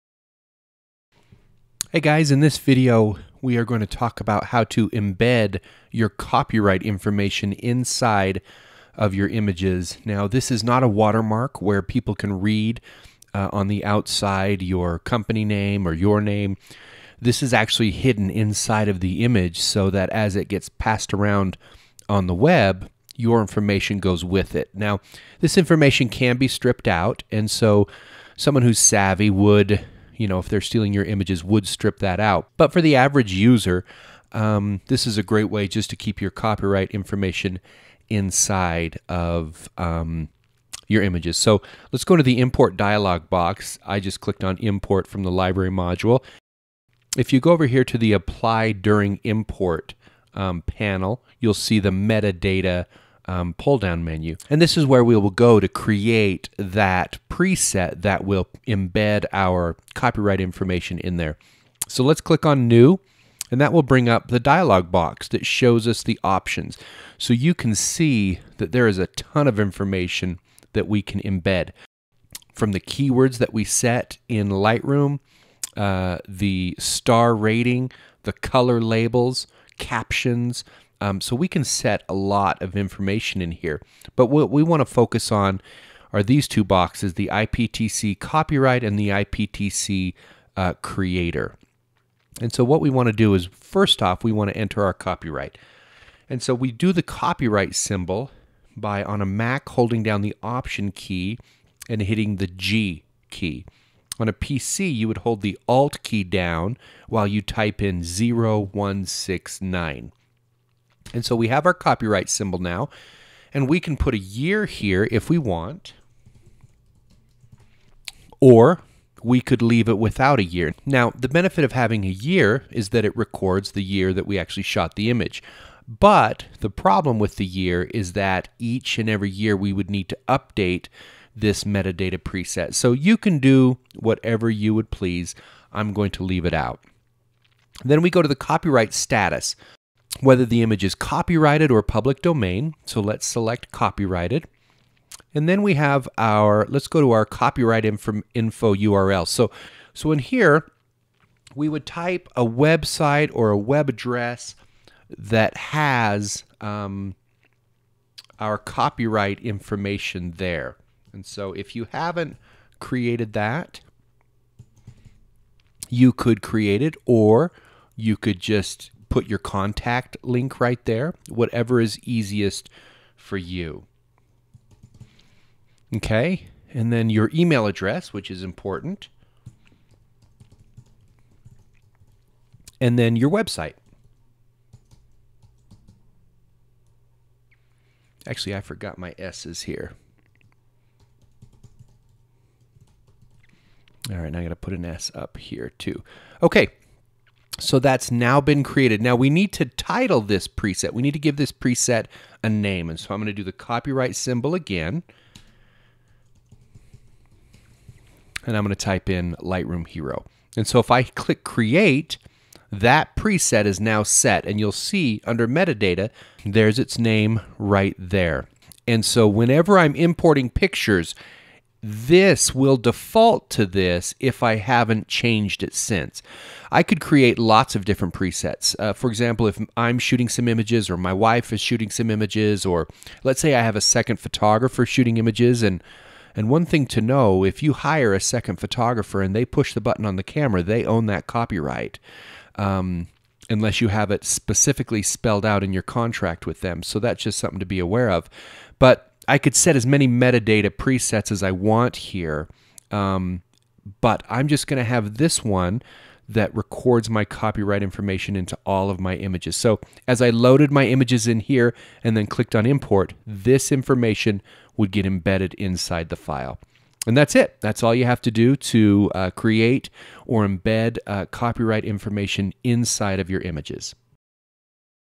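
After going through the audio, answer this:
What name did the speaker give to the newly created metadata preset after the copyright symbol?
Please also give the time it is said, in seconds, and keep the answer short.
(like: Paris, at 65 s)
Lightroom Hero, at 209 s.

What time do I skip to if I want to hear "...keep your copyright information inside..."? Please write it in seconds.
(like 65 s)
35 s.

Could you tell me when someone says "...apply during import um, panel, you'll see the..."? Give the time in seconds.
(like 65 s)
48 s.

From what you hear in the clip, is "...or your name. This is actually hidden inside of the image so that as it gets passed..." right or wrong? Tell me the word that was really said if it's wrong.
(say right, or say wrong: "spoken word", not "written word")
right.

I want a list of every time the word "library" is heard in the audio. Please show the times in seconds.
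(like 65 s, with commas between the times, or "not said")
45 s.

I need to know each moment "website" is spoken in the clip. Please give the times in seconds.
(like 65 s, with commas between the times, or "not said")
152 s, 183 s.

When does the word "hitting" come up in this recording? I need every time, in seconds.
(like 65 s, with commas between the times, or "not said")
102 s.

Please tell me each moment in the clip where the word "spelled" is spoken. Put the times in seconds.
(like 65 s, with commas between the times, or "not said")
245 s.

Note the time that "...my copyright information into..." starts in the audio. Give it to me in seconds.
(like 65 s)
257 s.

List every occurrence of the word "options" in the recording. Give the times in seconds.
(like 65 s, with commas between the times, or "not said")
66 s, 100 s.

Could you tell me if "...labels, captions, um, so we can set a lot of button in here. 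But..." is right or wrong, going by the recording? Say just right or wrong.
wrong.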